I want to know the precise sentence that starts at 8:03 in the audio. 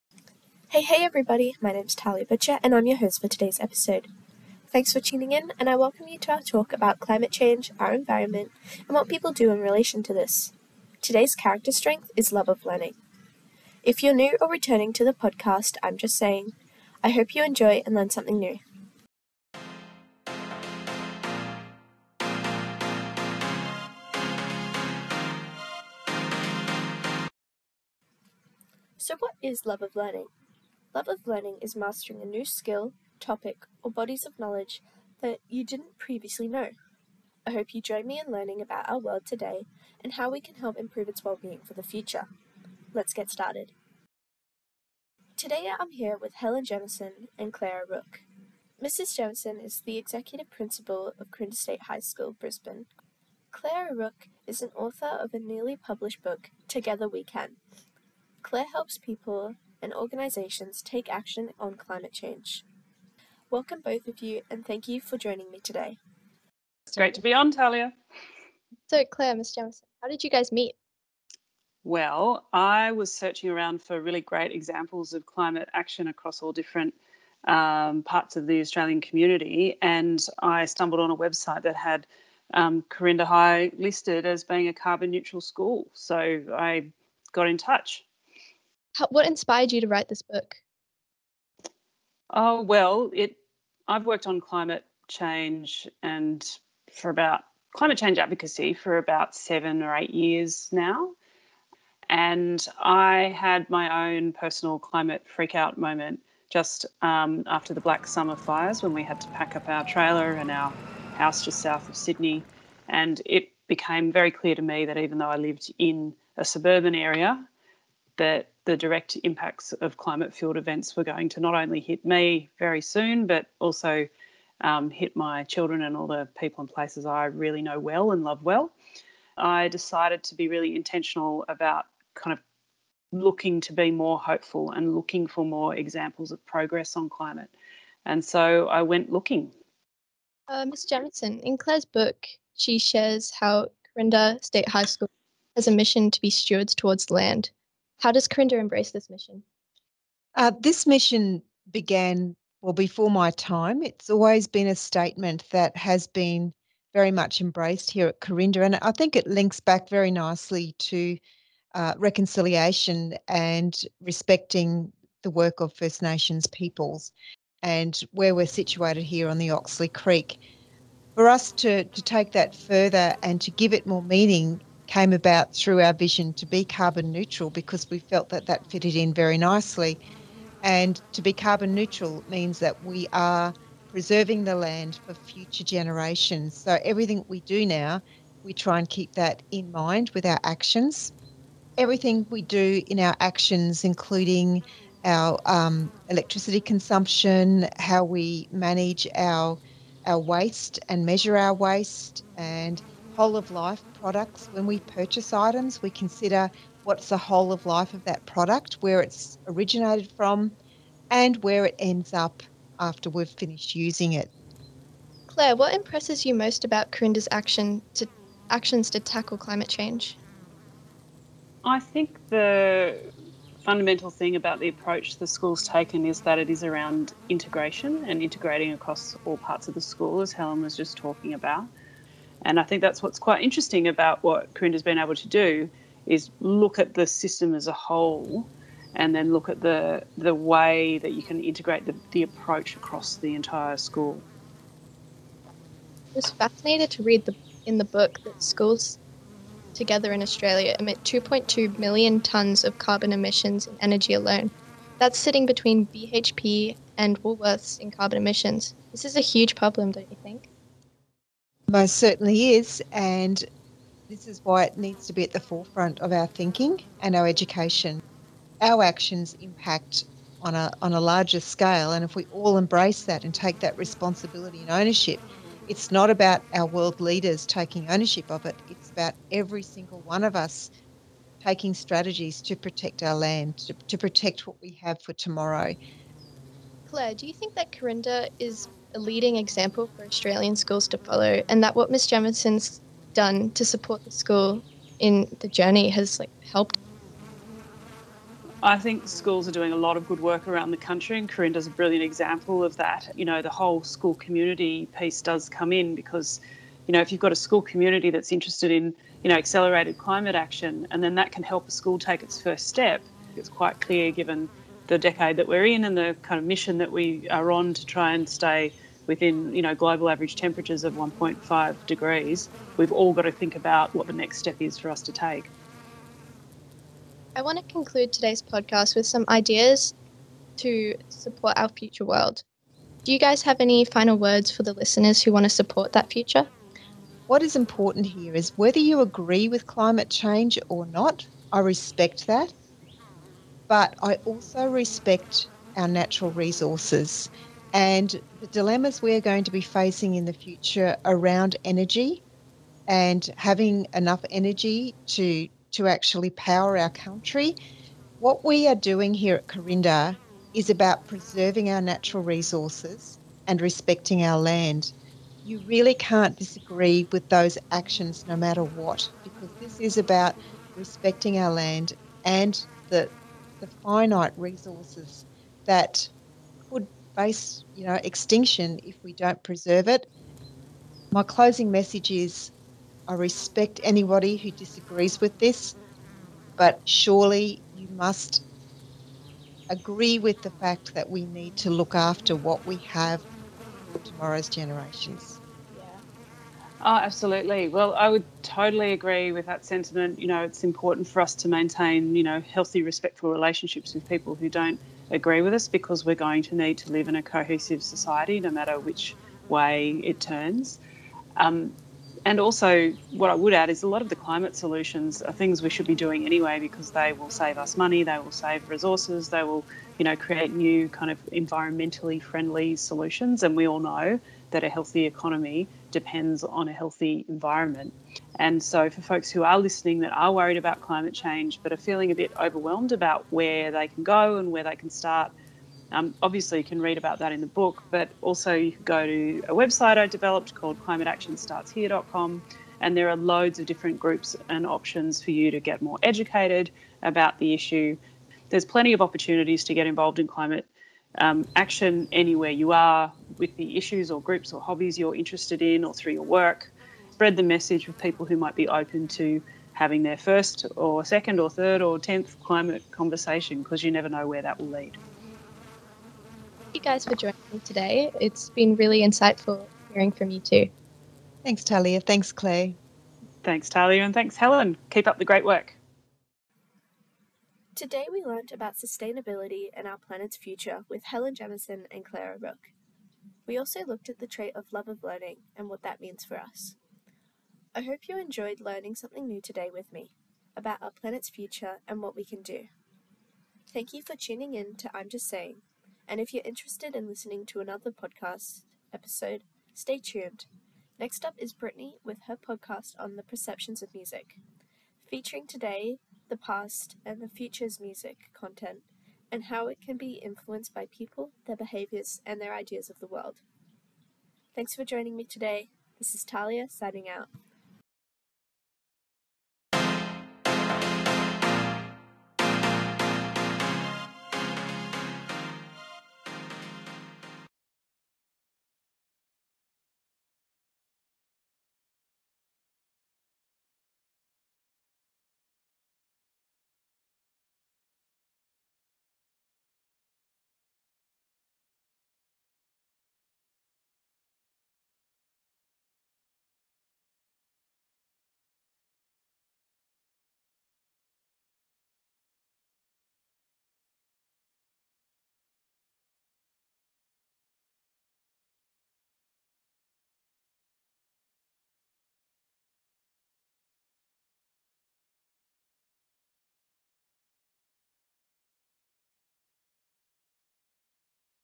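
We also looked at the trait of love of learning and what that means for us.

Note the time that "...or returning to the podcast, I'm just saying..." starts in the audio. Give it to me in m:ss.
0:14.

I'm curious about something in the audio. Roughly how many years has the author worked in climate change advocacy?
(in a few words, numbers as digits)
7 or 8 years.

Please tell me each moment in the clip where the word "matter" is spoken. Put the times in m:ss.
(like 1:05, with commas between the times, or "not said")
6:08, 6:48.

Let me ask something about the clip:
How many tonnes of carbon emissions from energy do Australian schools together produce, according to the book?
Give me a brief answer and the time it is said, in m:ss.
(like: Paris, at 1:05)
2.2 million tonnes, at 4:11.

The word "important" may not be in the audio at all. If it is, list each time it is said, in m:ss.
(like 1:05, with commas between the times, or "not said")
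5:37, 6:40.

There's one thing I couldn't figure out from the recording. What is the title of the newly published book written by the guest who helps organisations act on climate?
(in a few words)
Together We Can.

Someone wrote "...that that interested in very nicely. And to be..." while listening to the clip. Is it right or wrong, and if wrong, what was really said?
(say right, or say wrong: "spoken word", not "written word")
wrong: "fitted", not "interested".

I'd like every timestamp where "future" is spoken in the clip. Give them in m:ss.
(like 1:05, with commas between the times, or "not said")
0:41, 3:05, 5:31, 5:36, 5:50, 8:00, 8:11, 8:27.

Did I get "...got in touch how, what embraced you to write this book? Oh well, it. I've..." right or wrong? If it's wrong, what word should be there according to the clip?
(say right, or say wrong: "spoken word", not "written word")
wrong: "inspired", not "embraced".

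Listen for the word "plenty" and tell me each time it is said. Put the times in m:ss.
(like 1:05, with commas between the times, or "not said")
7:28.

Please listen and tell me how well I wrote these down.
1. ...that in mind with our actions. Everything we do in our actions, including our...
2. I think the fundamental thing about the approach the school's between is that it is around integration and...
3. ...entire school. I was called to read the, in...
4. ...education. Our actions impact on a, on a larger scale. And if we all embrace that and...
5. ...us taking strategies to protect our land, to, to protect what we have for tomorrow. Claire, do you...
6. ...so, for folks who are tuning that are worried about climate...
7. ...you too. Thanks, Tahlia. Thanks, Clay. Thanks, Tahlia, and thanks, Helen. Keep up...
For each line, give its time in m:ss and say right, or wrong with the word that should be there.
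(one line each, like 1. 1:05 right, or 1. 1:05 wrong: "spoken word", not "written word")
1. 3:09 right
2. 3:41 wrong: "taken", not "between"
3. 4:03 wrong: "fascinated", not "called"
4. 4:27 right
5. 4:40 right
6. 7:08 wrong: "listening", not "tuning"
7. 7:50 right.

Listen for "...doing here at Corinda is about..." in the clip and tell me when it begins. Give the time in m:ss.
5:58.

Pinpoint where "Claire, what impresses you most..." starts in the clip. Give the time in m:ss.
3:35.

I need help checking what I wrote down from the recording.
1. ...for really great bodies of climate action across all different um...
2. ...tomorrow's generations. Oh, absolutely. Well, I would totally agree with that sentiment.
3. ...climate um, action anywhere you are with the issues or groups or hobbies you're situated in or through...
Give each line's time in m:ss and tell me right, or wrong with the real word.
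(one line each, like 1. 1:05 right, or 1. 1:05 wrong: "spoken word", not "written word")
1. 1:13 wrong: "examples", not "bodies"
2. 6:33 right
3. 7:30 wrong: "interested", not "situated".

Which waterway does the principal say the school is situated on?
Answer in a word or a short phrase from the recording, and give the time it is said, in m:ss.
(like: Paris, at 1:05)
Oxley Creek, at 2:49.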